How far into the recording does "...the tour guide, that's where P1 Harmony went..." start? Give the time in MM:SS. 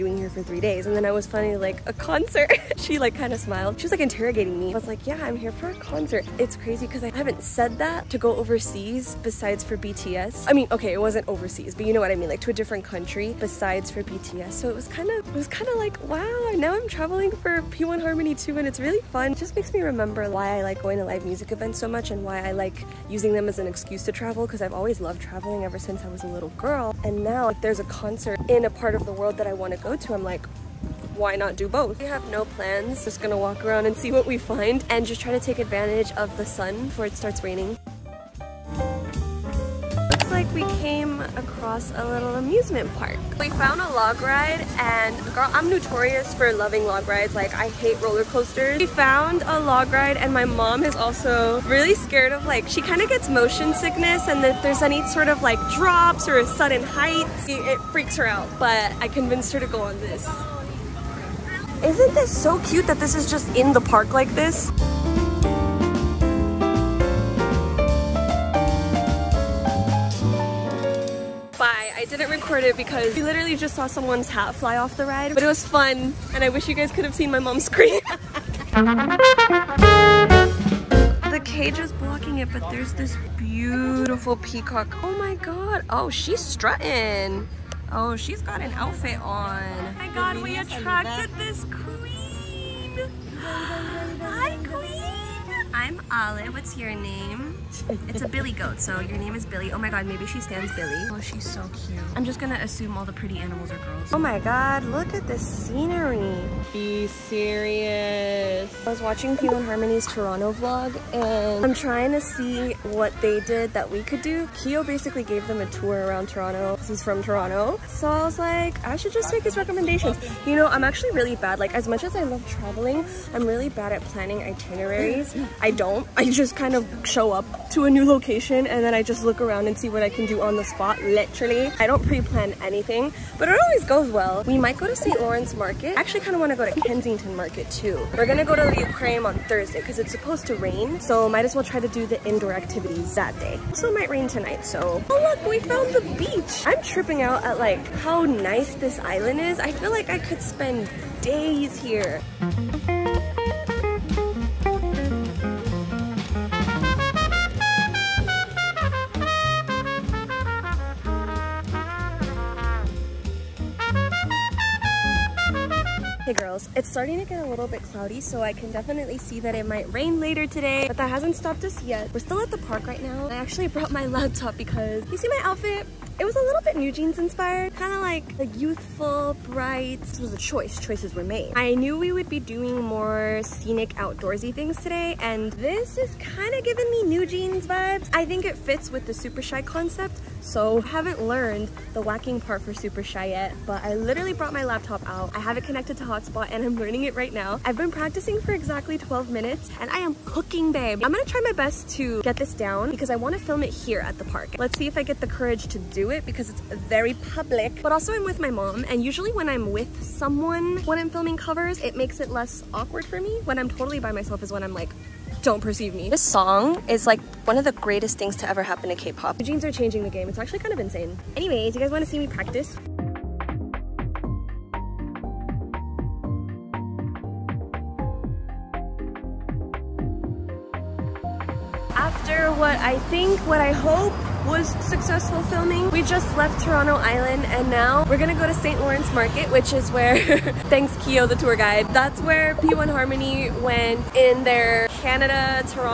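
04:01.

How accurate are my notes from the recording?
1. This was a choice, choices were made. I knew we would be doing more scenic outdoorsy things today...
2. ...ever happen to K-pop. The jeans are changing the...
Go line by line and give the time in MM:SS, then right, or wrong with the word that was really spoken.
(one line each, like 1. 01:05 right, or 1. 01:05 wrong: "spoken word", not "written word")
1. 03:00 right
2. 03:38 right.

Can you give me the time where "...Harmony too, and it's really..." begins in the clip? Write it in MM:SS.
00:18.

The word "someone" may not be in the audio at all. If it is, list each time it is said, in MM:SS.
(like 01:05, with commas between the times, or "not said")
01:13, 03:30.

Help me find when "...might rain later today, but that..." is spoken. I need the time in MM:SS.
02:49.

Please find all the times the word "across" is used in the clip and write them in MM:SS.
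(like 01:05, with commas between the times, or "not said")
00:41.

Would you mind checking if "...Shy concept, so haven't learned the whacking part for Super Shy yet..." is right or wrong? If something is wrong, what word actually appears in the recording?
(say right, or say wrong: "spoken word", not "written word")
right.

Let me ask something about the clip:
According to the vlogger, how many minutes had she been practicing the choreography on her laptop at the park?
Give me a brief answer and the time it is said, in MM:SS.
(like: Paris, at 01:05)
12, at 03:18.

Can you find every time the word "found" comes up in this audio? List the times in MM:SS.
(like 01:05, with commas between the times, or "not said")
00:43, 00:48, 02:25.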